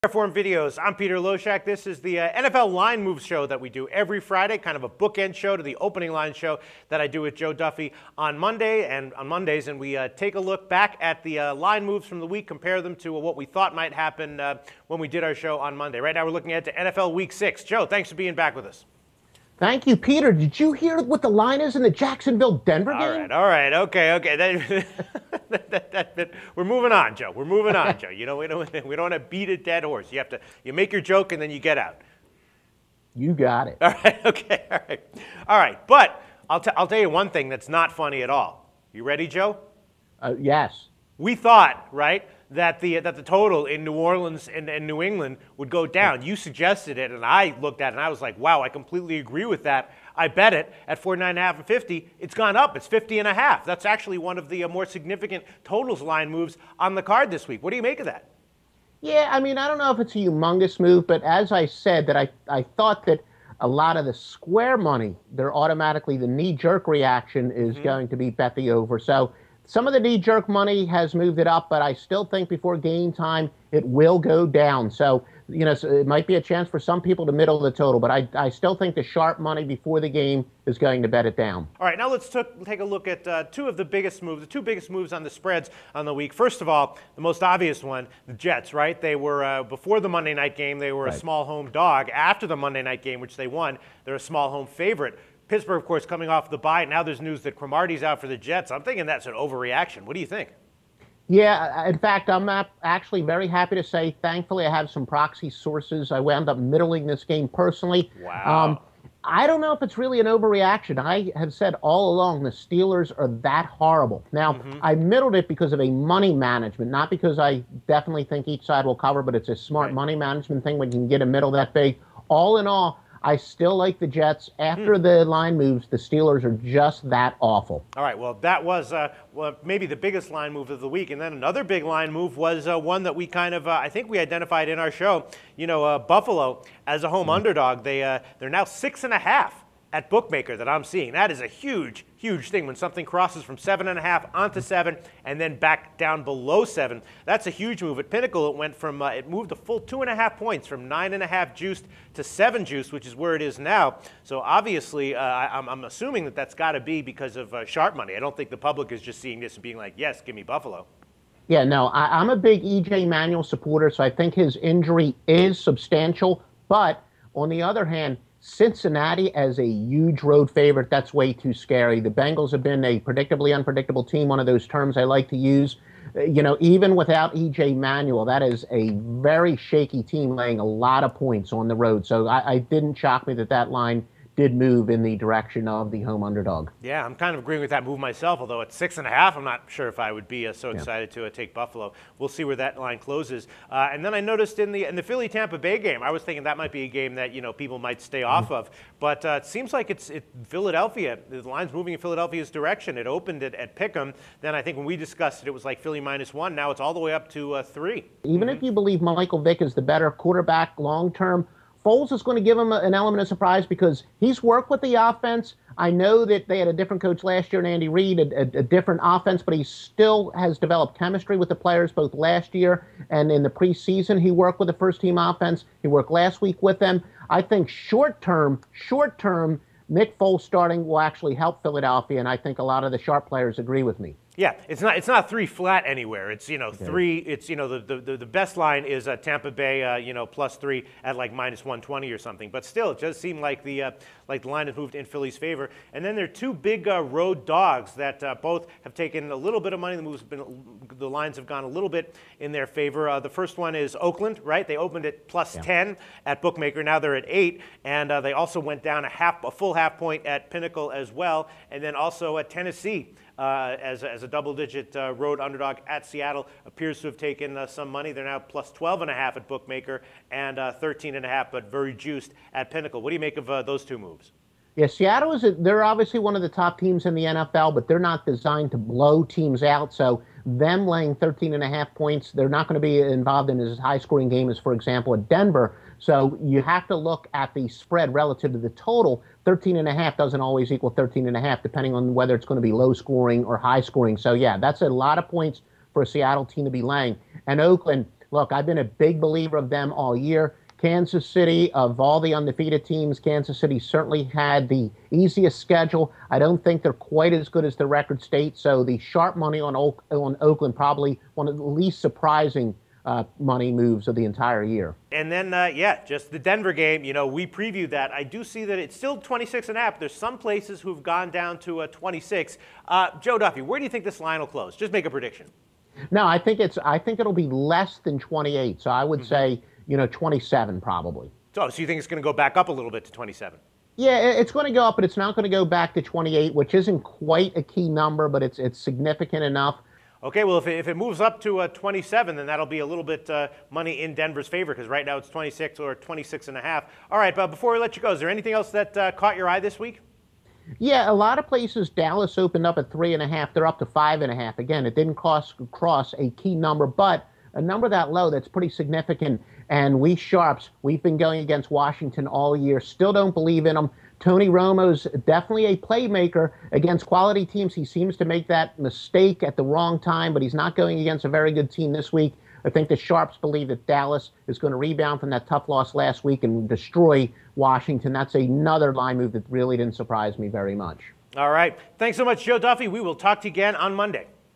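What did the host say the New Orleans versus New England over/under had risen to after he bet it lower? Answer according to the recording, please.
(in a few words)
50.5.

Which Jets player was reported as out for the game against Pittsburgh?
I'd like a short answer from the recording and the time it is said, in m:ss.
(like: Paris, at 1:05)
Cromartie, at 1:37.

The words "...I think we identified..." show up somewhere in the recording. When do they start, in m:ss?
2:13.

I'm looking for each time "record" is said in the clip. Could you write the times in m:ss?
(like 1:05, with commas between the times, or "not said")
5:07.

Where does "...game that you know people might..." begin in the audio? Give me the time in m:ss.
3:16.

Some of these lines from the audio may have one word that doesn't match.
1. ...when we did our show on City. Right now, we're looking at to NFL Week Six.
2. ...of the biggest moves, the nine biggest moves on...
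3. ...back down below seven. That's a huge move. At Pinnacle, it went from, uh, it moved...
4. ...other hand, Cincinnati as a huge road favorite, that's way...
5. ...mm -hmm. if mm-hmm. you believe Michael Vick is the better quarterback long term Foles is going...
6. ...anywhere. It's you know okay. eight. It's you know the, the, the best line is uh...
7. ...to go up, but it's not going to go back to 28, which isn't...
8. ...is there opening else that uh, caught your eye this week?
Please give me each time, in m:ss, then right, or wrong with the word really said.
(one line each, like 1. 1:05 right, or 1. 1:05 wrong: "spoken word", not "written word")
1. 0:14 wrong: "Monday", not "City"
2. 1:23 wrong: "two", not "nine"
3. 2:25 right
4. 2:47 right
5. 3:28 right
6. 3:55 wrong: "three", not "eight"
7. 5:34 right
8. 5:48 wrong: "anything", not "opening".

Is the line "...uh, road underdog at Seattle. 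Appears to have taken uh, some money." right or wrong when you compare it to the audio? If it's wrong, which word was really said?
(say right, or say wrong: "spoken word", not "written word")
right.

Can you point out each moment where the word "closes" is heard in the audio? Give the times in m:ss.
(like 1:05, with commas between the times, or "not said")
3:12, 5:24.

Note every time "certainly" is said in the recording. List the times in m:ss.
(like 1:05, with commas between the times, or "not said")
5:03.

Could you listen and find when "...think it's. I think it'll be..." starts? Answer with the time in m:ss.
5:26.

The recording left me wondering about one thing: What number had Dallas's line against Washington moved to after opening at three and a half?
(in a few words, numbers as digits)
5.5.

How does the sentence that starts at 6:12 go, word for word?
I think the Sharps believe that Dallas is going to rebound from that tough loss last week and destroy Washington.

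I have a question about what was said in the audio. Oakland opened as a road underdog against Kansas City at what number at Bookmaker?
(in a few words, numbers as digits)
10.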